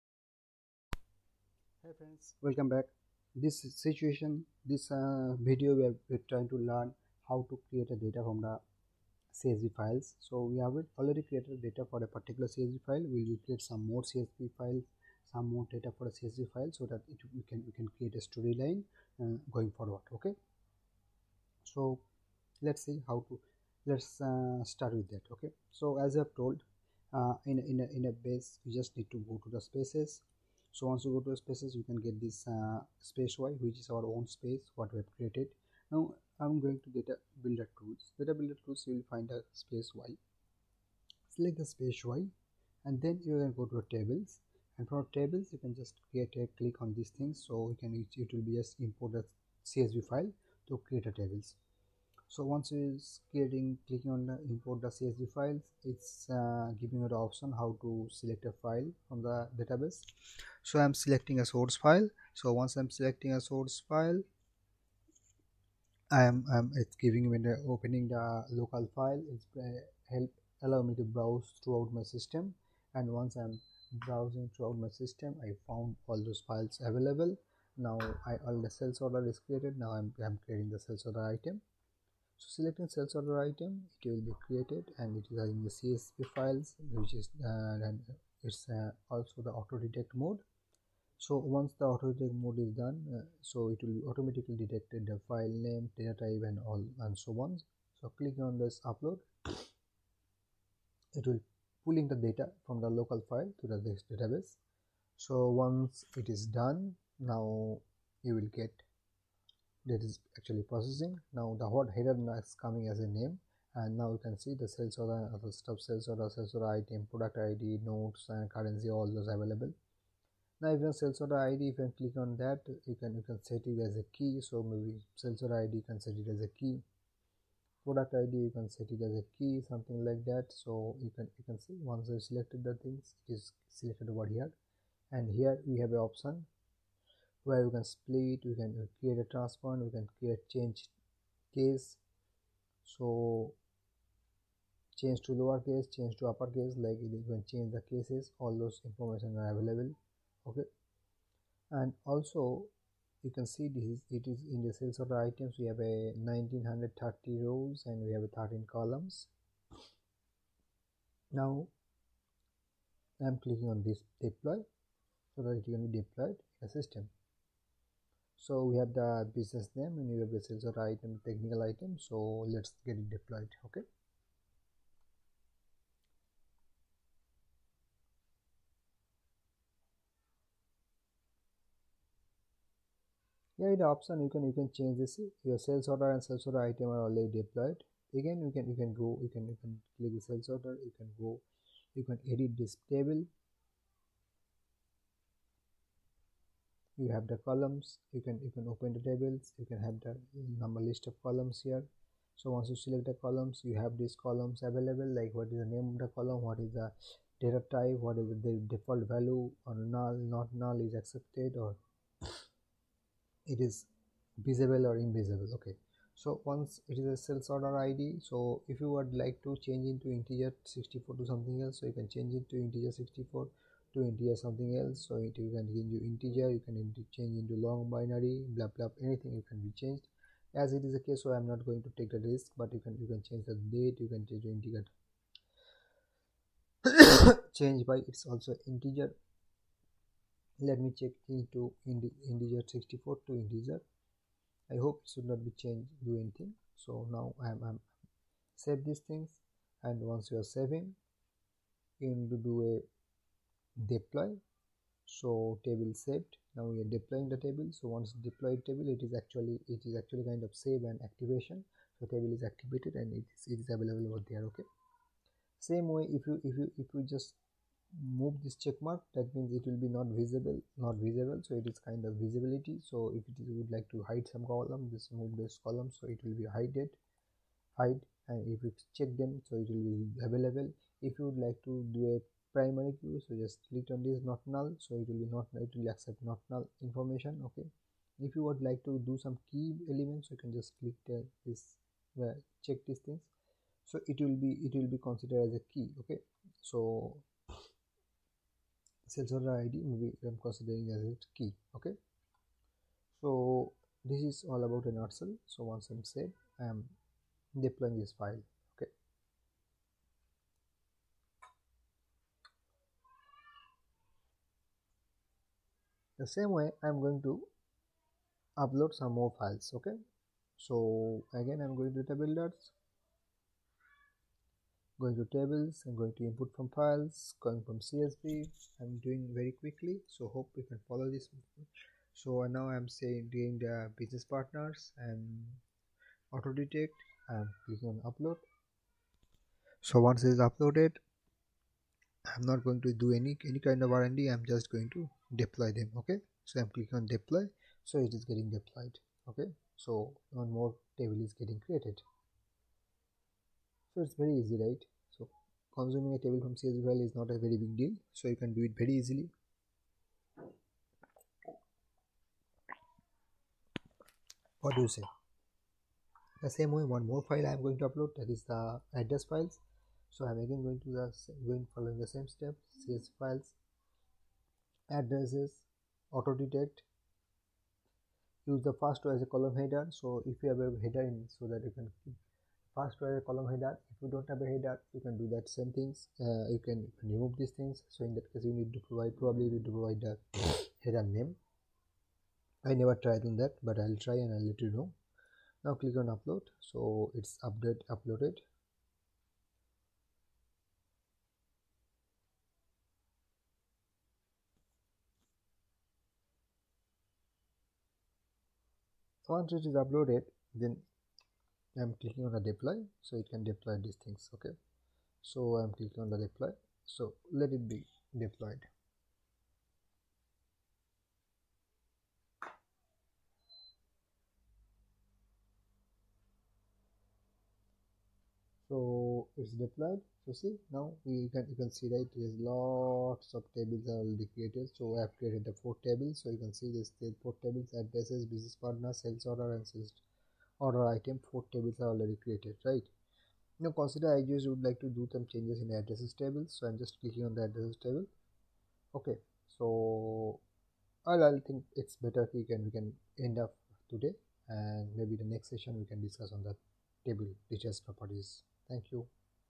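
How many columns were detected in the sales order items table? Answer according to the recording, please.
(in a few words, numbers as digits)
13.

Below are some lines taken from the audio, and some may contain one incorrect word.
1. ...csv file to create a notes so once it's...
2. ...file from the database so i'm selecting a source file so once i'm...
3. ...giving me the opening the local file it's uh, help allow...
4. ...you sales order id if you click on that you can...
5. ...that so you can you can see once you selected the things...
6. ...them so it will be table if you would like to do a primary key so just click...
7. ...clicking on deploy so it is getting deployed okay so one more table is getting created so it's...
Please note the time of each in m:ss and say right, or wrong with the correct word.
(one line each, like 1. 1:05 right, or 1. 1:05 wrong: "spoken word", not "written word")
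1. 0:49 wrong: "tables", not "notes"
2. 0:58 right
3. 1:07 right
4. 2:00 right
5. 2:10 right
6. 4:39 wrong: "available", not "table"
7. 5:46 right.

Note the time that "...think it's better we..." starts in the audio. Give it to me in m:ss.
7:31.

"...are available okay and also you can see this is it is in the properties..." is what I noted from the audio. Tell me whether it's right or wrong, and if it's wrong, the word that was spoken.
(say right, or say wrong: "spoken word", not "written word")
wrong: "sales", not "properties".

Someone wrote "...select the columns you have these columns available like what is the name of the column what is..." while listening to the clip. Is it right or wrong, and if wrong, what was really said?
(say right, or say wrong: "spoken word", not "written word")
right.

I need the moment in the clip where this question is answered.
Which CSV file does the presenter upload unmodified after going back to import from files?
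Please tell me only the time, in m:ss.
5:33.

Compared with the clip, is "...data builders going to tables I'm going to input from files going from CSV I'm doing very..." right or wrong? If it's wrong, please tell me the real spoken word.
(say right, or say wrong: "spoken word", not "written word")
right.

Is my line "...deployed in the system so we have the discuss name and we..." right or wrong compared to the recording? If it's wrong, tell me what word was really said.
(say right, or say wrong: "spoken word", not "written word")
wrong: "business", not "discuss".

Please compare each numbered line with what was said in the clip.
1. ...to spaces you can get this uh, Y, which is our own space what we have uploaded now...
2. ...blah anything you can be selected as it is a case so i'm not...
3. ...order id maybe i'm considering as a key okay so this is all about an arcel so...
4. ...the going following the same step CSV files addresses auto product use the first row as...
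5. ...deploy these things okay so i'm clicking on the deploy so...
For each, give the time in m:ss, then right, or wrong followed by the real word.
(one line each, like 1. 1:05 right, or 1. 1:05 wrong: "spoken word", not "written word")
1. 0:31 wrong: "created", not "uploaded"
2. 3:48 wrong: "changed", not "selected"
3. 4:59 right
4. 6:10 wrong: "detect", not "product"
5. 6:53 right.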